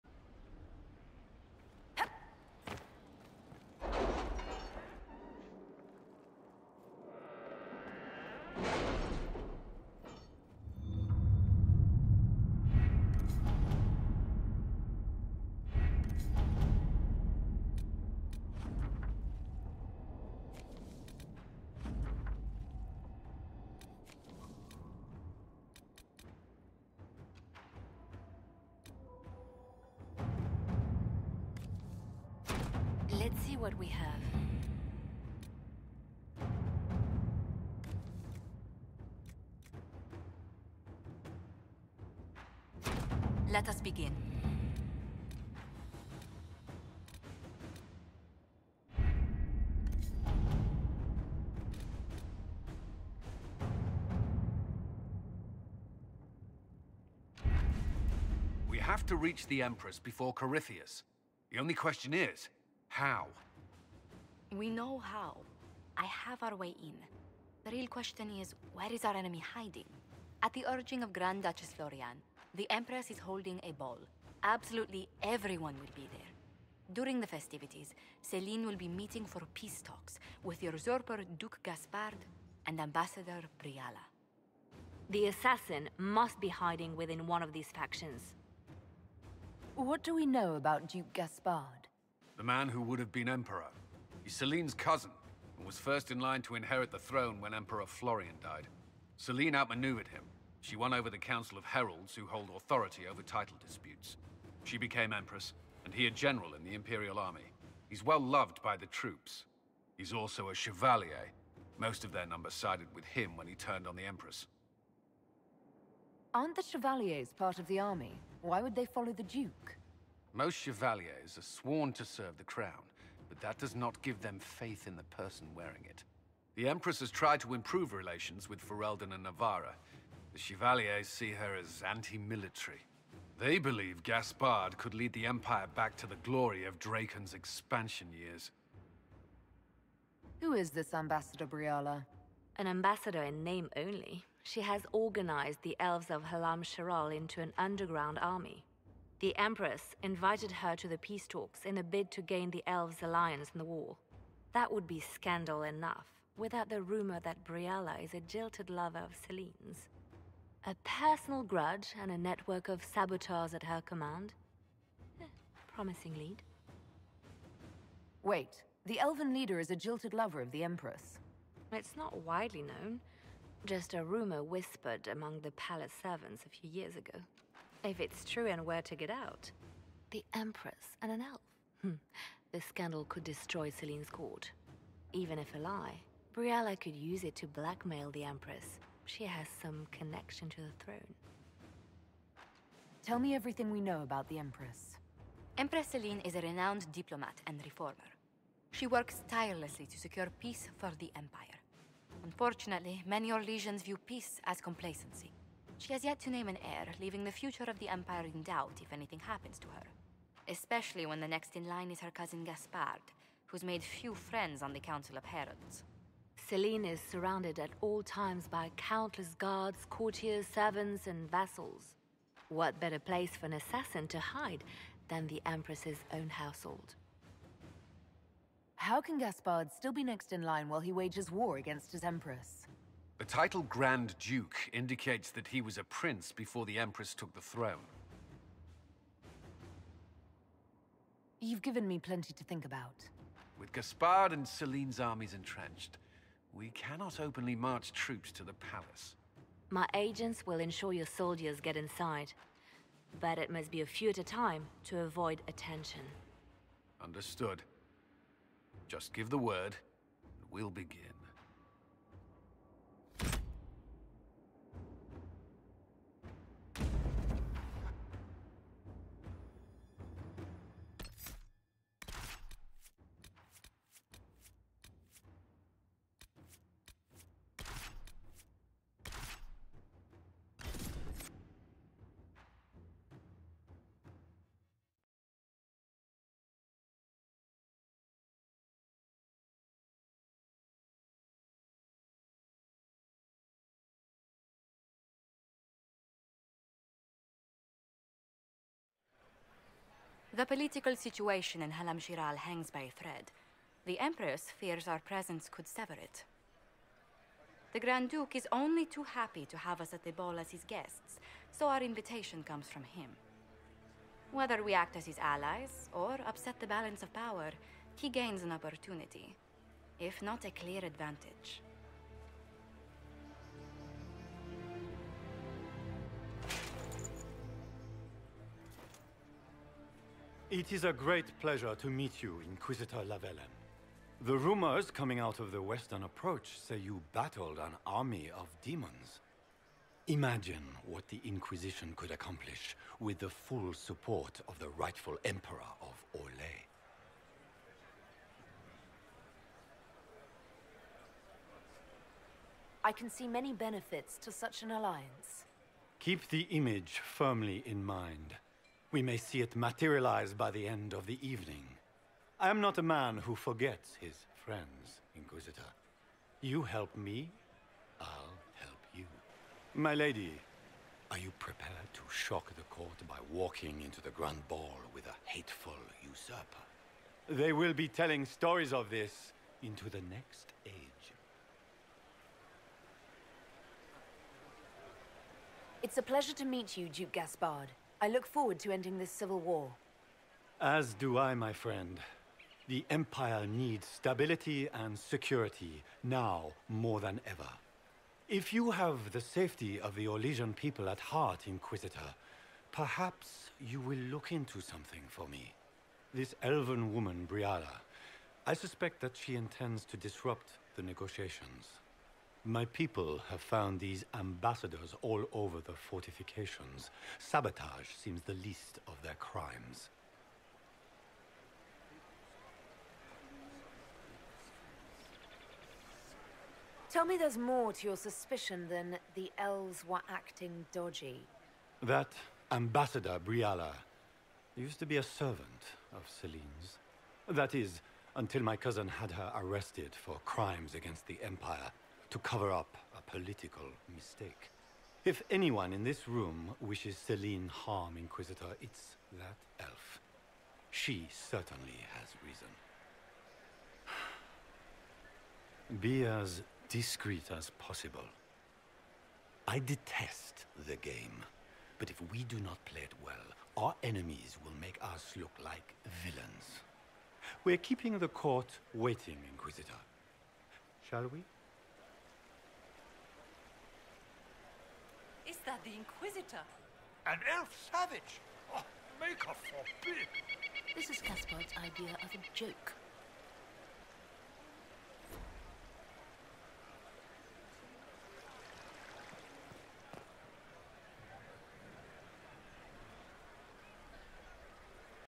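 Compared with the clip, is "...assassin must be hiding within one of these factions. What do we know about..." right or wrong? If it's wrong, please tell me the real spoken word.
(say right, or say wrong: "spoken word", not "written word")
right.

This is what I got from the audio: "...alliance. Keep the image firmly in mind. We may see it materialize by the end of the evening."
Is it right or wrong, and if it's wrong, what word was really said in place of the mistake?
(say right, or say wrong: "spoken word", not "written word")
right.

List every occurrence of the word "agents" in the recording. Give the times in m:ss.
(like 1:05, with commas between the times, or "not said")
4:09.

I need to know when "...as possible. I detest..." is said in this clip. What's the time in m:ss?
7:37.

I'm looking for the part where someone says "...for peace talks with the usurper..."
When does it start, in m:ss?
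1:19.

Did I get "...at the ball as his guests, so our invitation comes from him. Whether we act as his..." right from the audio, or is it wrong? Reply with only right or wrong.
right.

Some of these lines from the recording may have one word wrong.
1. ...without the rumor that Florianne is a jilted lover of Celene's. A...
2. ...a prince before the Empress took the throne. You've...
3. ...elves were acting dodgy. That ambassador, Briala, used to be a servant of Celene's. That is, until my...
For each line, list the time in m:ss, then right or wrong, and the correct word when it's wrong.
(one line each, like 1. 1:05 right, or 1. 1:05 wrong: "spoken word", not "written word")
1. 2:36 wrong: "Briala", not "Florianne"
2. 3:55 right
3. 7:09 right.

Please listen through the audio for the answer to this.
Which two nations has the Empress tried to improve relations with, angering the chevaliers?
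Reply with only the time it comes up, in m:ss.
2:08.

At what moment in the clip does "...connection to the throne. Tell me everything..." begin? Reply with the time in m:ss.
3:09.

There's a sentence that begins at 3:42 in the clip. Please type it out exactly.
What better place for an assassin to hide than the Empress's own household?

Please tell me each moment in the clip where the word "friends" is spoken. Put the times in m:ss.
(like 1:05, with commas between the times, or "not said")
3:34, 6:04, 6:31.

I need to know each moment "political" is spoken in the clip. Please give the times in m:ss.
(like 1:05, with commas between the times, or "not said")
5:00, 7:23.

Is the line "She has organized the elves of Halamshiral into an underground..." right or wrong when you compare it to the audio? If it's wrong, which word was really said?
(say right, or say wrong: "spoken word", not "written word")
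right.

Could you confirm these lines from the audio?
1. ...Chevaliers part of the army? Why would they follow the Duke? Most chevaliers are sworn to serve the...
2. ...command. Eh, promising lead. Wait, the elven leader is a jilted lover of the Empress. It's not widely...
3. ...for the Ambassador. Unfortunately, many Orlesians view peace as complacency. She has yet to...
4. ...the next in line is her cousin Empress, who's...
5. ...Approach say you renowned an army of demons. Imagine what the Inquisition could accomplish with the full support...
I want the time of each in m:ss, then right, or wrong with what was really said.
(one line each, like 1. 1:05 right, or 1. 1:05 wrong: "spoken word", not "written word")
1. 1:56 right
2. 2:43 right
3. 3:20 wrong: "Empire", not "Ambassador"
4. 3:31 wrong: "Gaspard", not "Empress"
5. 5:36 wrong: "battled", not "renowned".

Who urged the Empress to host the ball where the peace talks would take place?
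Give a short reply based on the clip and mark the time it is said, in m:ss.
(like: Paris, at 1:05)
Grand Duchess Florianne, at 1:11.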